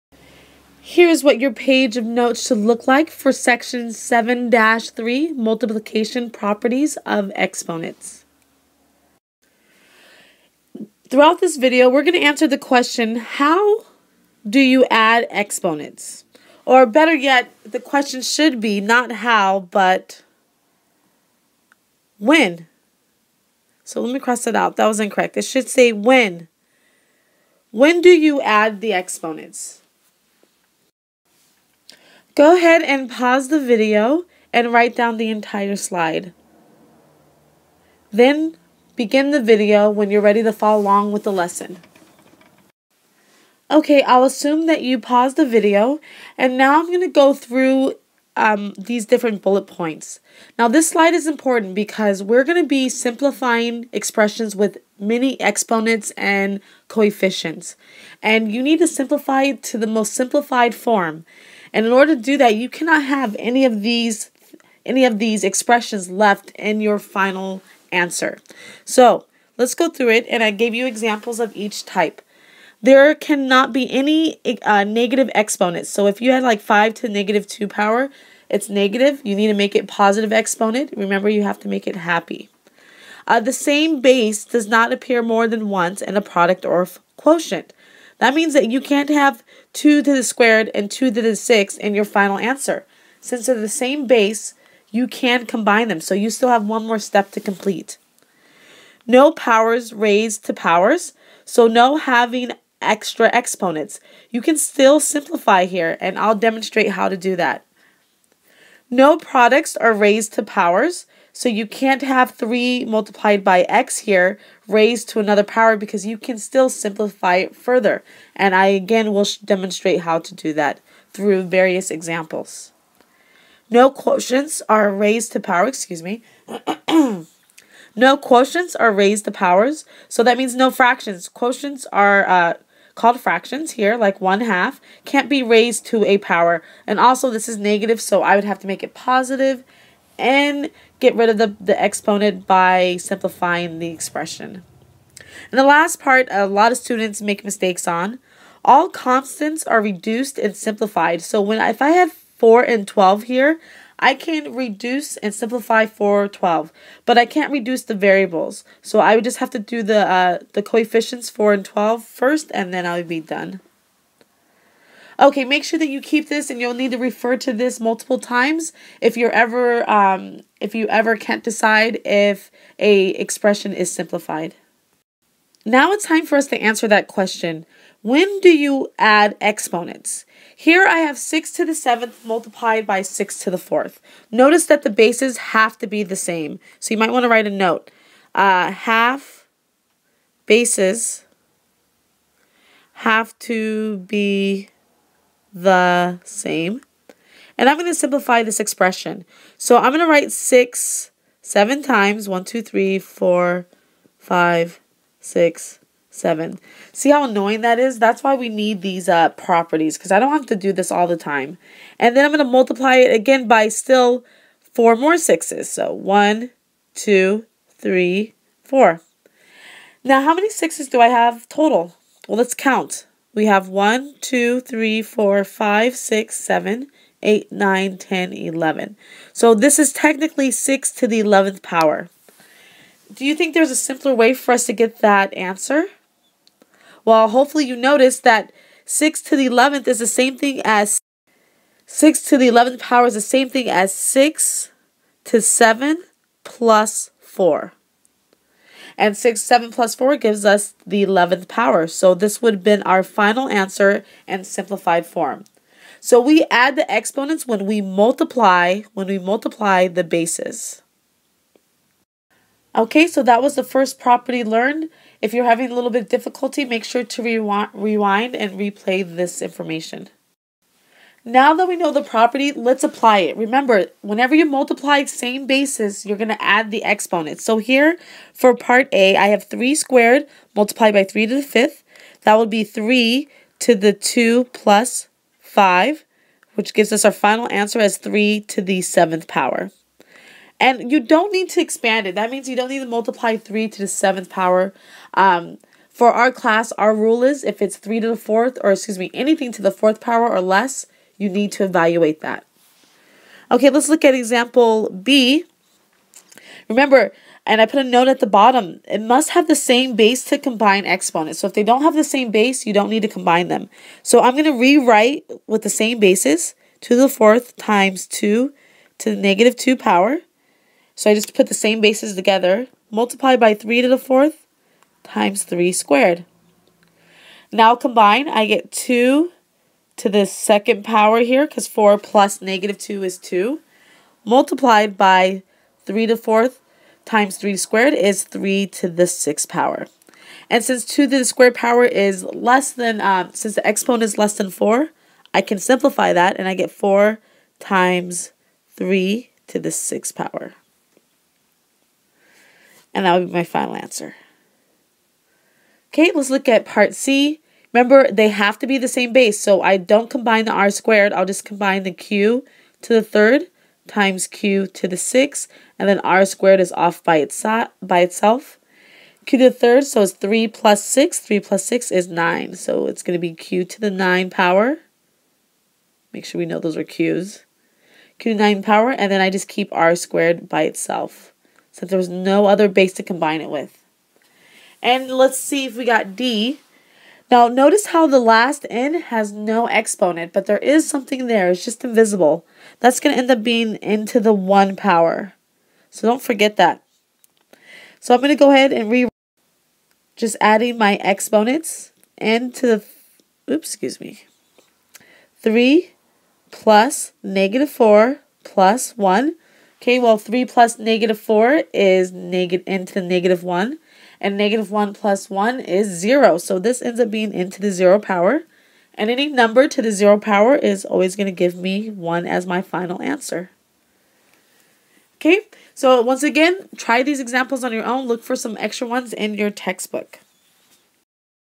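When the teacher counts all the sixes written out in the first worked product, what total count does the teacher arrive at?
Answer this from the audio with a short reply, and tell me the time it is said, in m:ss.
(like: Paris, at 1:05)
11, at 3:48.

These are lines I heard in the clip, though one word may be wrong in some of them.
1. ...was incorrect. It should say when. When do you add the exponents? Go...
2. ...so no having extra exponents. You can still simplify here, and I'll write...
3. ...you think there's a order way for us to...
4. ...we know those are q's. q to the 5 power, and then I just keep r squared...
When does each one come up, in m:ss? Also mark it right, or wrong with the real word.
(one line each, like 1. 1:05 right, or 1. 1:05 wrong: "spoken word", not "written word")
1. 0:24 right
2. 1:41 wrong: "demonstrate", not "write"
3. 3:53 wrong: "simpler", not "order"
4. 6:16 wrong: "9", not "5".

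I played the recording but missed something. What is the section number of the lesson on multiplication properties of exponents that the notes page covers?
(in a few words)
7-3.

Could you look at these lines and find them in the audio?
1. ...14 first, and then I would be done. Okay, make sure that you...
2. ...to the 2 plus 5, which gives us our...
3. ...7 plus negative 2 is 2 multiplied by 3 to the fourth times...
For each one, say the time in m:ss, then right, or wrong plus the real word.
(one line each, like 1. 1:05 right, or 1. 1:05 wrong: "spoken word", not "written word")
1. 2:41 wrong: "12", not "14"
2. 4:43 right
3. 5:31 wrong: "4", not "7".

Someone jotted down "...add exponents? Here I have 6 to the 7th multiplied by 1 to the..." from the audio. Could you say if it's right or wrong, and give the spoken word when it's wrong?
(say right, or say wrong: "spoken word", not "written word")
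wrong: "6", not "1".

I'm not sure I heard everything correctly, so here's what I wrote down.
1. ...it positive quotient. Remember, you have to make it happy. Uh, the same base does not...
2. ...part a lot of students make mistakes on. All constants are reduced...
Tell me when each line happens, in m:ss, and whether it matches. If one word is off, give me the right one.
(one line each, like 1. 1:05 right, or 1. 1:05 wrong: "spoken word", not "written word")
1. 1:19 wrong: "exponent", not "quotient"
2. 2:25 right.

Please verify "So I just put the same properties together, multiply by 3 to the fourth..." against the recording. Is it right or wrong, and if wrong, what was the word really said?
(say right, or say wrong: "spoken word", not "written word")
wrong: "bases", not "properties".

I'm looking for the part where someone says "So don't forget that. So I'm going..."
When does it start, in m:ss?
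6:35.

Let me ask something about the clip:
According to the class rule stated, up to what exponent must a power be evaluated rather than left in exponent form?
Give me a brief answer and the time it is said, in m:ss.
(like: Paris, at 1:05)
4, at 4:59.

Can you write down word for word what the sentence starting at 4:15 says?
So we add the exponents when we multiply, when we multiply the bases.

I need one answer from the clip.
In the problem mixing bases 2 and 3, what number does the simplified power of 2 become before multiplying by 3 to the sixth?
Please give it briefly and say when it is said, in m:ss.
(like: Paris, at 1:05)
4, at 5:46.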